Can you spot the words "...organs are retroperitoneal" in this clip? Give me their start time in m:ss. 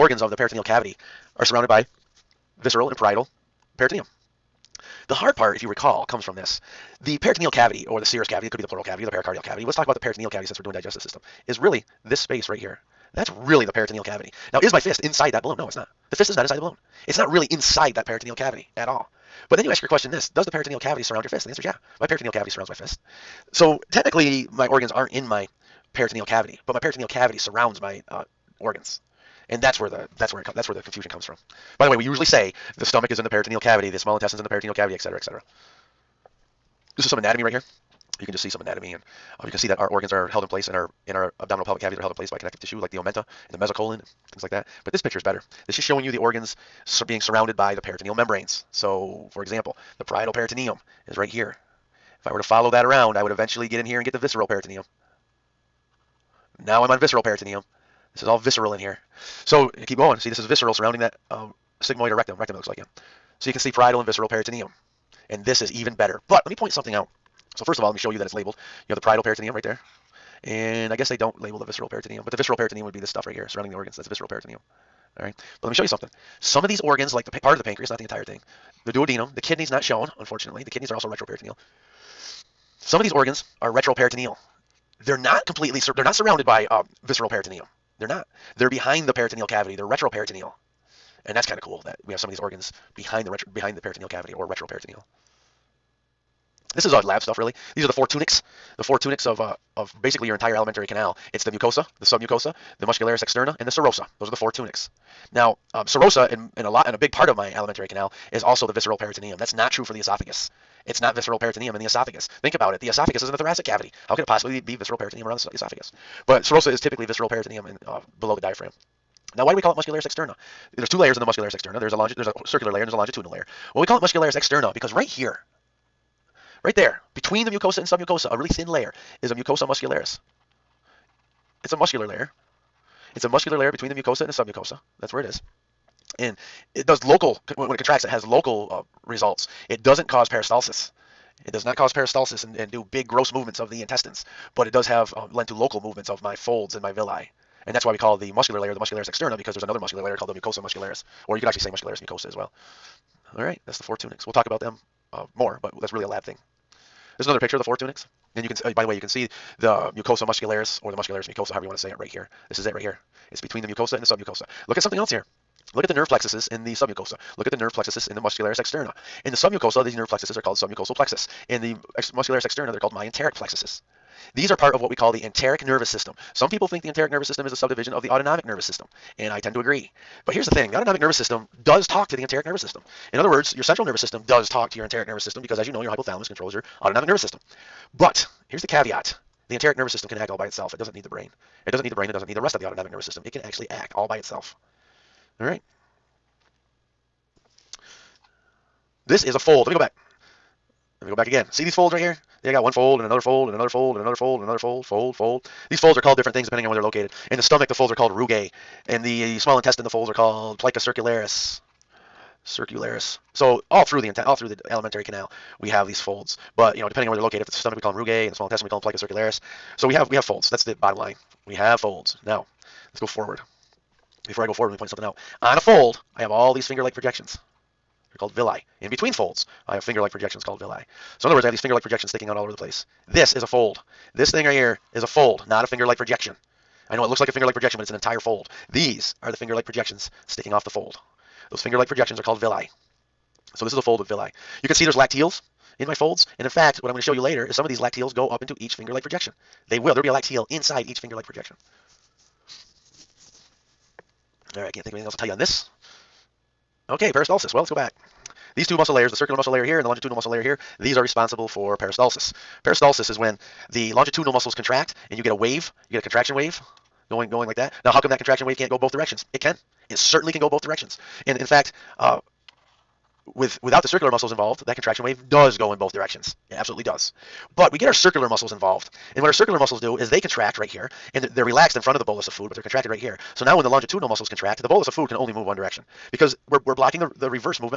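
1:23.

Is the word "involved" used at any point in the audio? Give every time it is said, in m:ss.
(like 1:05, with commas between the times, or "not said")
4:34, 4:38.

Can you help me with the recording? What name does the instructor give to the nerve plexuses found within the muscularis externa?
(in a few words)
Myenteric plexuses.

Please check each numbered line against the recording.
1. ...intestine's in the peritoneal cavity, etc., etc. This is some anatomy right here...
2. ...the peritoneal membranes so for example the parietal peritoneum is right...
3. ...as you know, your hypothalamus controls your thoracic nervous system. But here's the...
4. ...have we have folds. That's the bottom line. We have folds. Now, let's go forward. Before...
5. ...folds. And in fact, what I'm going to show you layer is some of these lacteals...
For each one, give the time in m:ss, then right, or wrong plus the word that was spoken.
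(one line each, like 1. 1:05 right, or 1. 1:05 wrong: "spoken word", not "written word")
1. 0:34 right
2. 0:47 right
3. 3:05 wrong: "autonomic", not "thoracic"
4. 3:39 right
5. 4:05 wrong: "later", not "layer".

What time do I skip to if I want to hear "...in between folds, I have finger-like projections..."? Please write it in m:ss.
3:48.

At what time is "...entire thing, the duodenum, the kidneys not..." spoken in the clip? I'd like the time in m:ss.
1:18.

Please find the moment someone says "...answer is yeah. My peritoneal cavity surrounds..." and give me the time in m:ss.
0:21.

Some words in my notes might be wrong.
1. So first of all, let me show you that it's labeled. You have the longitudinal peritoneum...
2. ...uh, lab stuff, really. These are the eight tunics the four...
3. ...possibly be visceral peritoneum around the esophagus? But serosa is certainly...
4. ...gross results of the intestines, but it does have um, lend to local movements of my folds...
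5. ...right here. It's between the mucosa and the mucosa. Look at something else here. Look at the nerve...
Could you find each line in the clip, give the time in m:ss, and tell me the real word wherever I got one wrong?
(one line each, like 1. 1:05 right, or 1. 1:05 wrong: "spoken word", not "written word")
1. 1:07 wrong: "parietal", not "longitudinal"
2. 1:36 wrong: "four", not "eight"
3. 1:54 wrong: "typically", not "certainly"
4. 2:23 wrong: "movements", not "results"
5. 2:42 wrong: "submucosa", not "mucosa".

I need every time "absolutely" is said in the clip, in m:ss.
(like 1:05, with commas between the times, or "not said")
4:36.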